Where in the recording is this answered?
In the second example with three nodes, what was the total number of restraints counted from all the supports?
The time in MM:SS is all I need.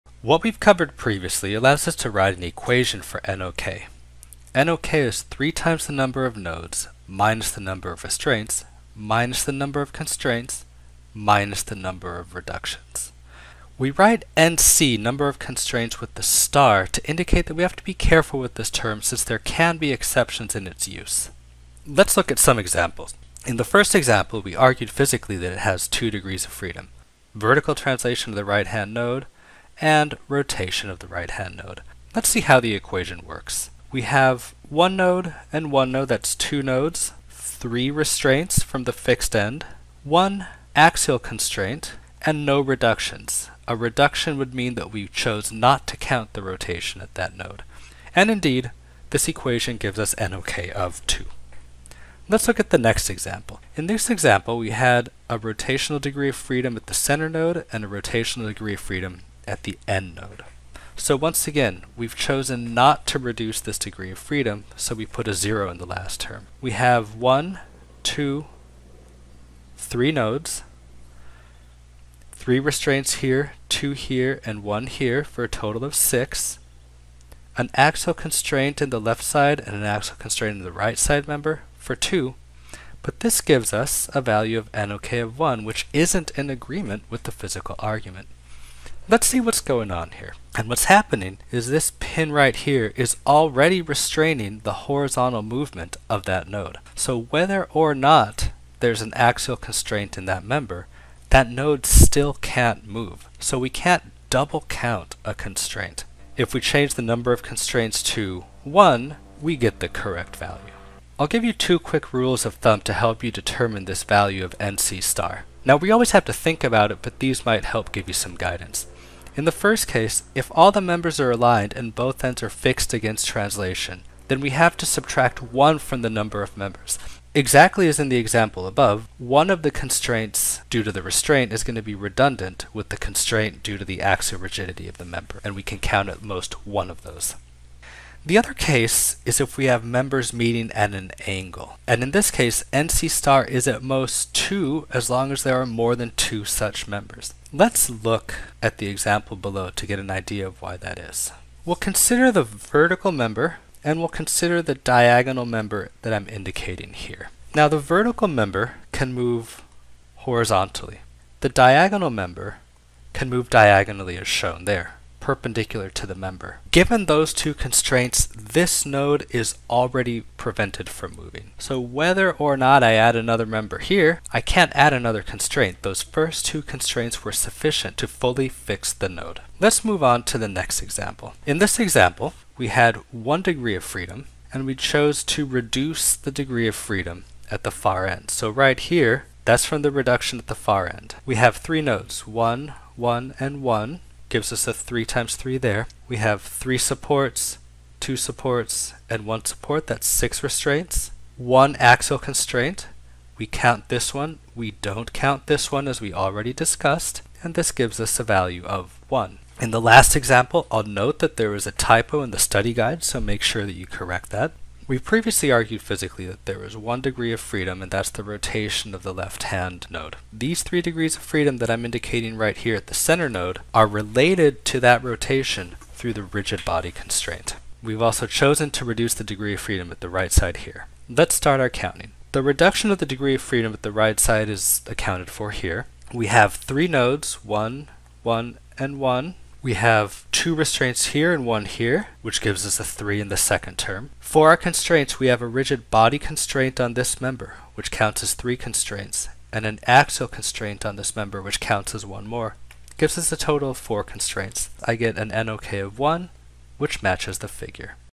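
01:15.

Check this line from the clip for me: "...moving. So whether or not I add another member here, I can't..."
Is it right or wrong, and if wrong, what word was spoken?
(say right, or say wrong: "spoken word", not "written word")
right.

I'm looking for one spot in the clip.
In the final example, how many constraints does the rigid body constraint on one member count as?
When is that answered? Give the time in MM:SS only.
04:07.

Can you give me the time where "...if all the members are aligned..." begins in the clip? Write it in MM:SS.
02:00.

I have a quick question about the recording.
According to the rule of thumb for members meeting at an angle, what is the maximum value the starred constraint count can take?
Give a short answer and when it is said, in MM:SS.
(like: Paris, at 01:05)
2, at 02:23.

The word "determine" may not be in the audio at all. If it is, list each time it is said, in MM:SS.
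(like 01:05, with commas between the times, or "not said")
01:53.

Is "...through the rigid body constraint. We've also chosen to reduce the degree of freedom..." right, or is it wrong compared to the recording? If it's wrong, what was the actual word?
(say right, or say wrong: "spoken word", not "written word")
right.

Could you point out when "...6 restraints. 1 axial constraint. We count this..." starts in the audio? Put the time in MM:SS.
03:20.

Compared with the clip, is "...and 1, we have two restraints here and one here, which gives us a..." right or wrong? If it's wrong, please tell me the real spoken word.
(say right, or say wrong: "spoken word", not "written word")
right.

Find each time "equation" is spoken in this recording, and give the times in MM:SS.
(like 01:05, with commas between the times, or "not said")
00:02, 00:32, 00:49.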